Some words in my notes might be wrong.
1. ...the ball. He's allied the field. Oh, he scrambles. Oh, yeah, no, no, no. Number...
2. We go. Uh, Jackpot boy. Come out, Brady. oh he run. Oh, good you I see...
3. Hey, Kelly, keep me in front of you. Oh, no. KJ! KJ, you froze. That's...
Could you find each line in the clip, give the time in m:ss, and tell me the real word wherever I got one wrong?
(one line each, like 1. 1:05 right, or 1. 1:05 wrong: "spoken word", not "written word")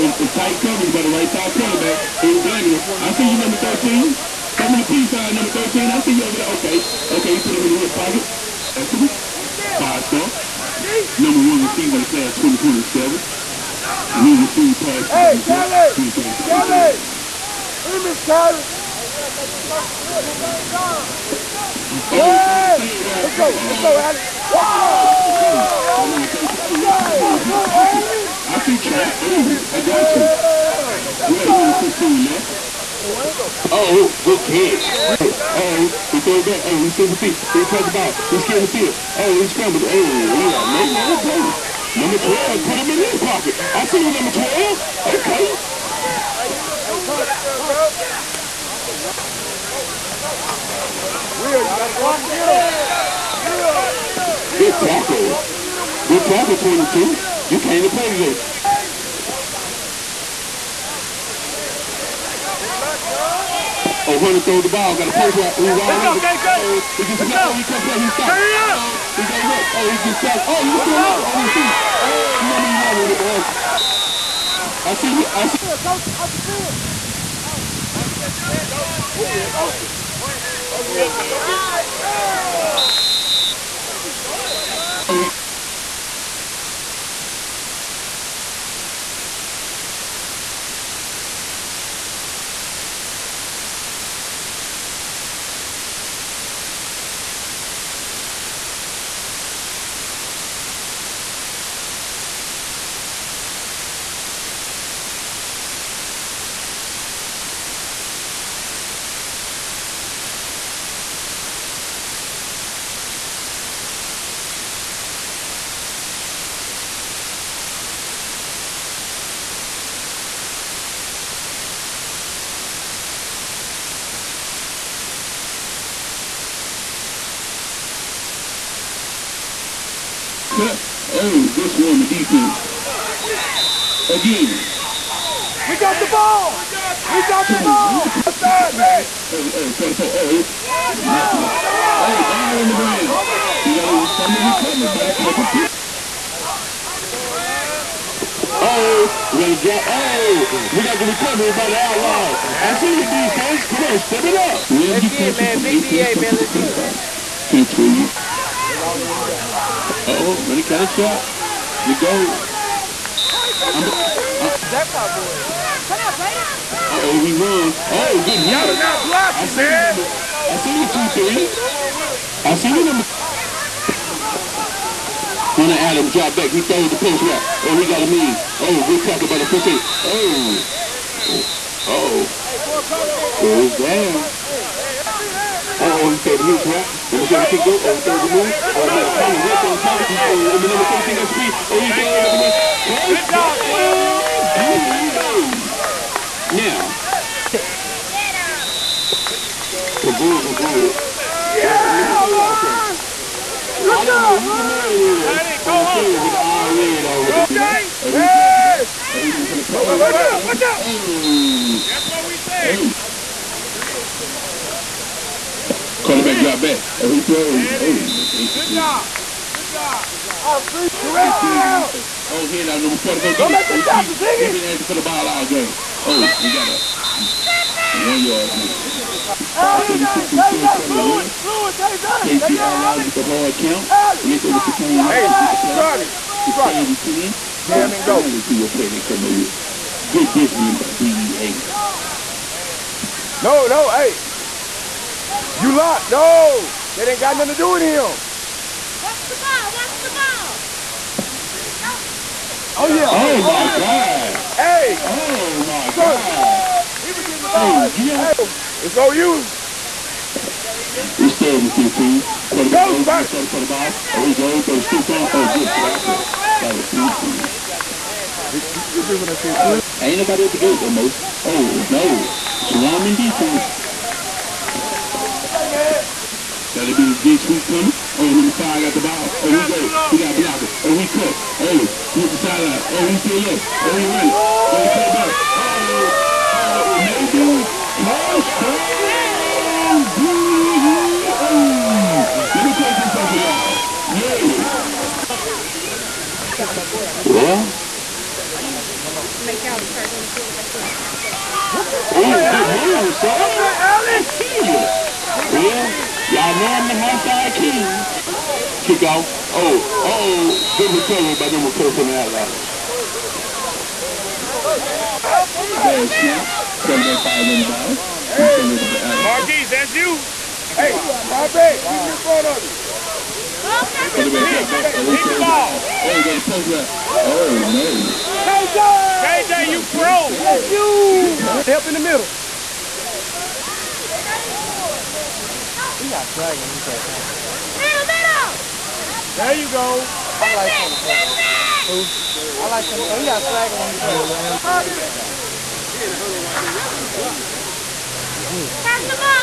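1. 0:37 wrong: "scared", not "allied"
2. 2:41 right
3. 5:20 wrong: "Robbie", not "Kelly".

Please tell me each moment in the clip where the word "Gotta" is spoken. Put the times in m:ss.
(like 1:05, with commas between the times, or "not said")
4:36.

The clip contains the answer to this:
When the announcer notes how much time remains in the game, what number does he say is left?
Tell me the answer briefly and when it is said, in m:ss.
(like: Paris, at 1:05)
116, at 0:31.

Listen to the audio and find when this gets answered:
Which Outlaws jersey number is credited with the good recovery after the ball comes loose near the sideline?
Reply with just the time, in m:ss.
5:11.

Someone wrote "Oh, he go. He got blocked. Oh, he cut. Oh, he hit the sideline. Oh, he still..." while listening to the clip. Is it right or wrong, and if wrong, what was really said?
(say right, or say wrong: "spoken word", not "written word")
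right.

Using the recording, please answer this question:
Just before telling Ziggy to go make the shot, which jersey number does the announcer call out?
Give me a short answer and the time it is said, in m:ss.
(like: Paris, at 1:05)
44, at 3:42.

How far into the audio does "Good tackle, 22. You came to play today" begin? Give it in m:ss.
0:56.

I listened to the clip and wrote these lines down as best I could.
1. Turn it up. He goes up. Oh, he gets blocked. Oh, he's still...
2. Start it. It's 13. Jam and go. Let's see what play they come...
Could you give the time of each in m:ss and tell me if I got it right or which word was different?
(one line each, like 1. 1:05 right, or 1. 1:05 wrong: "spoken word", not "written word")
1. 1:08 wrong: "tapped", not "blocked"
2. 3:56 wrong: "10", not "13".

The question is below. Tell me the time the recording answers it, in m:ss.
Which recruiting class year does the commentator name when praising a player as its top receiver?
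0:12.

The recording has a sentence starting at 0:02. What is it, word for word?
Ain't blaming I see you, number 13.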